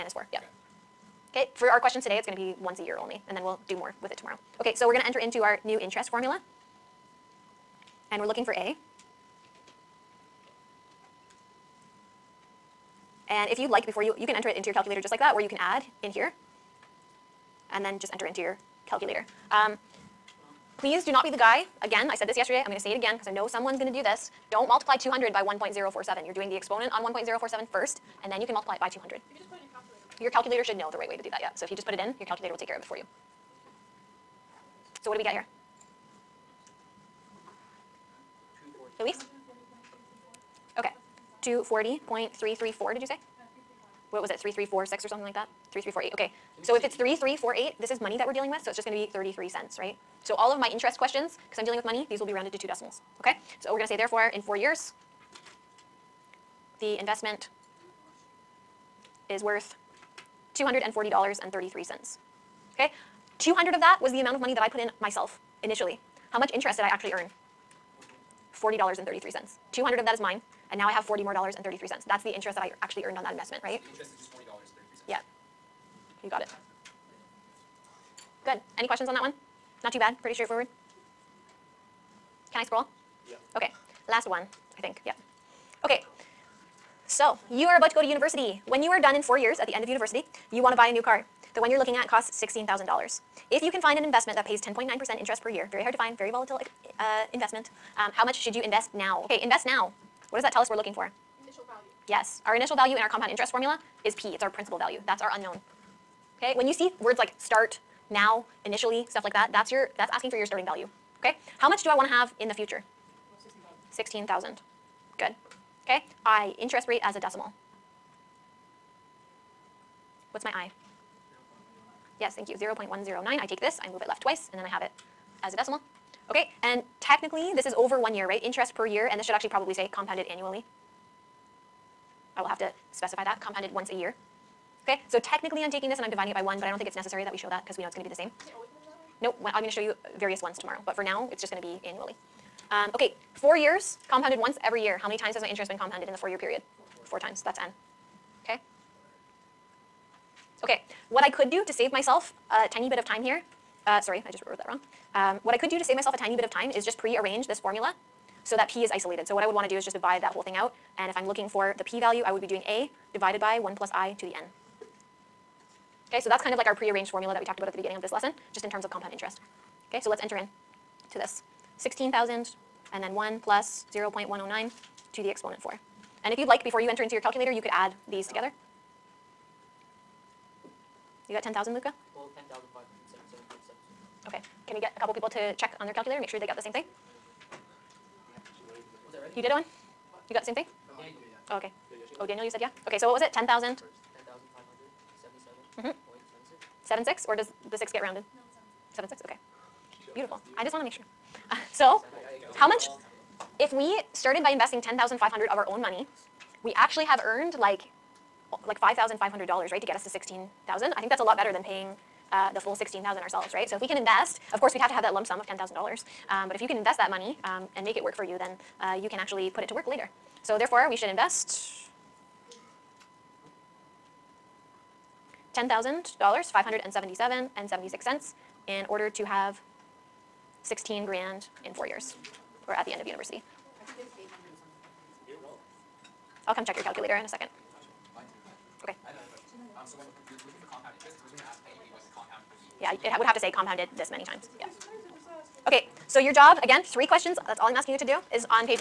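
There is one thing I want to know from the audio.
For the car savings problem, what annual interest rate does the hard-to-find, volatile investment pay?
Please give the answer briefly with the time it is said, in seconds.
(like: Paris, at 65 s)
10.9%, at 94 s.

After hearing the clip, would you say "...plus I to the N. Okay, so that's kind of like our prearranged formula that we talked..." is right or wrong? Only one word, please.
right.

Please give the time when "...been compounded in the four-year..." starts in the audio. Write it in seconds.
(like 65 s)
145 s.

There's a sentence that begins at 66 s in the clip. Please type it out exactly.
How much interest did I actually earn?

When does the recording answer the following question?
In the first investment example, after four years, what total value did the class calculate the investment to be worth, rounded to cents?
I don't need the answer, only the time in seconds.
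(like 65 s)
60 s.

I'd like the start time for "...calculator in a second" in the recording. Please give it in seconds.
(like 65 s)
236 s.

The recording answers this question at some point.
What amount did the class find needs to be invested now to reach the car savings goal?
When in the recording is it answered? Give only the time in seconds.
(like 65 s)
195 s.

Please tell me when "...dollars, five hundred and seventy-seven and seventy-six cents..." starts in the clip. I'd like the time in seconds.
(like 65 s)
226 s.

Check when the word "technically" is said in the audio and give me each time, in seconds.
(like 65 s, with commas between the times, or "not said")
127 s, 135 s.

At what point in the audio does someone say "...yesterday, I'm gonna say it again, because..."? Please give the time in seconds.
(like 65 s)
22 s.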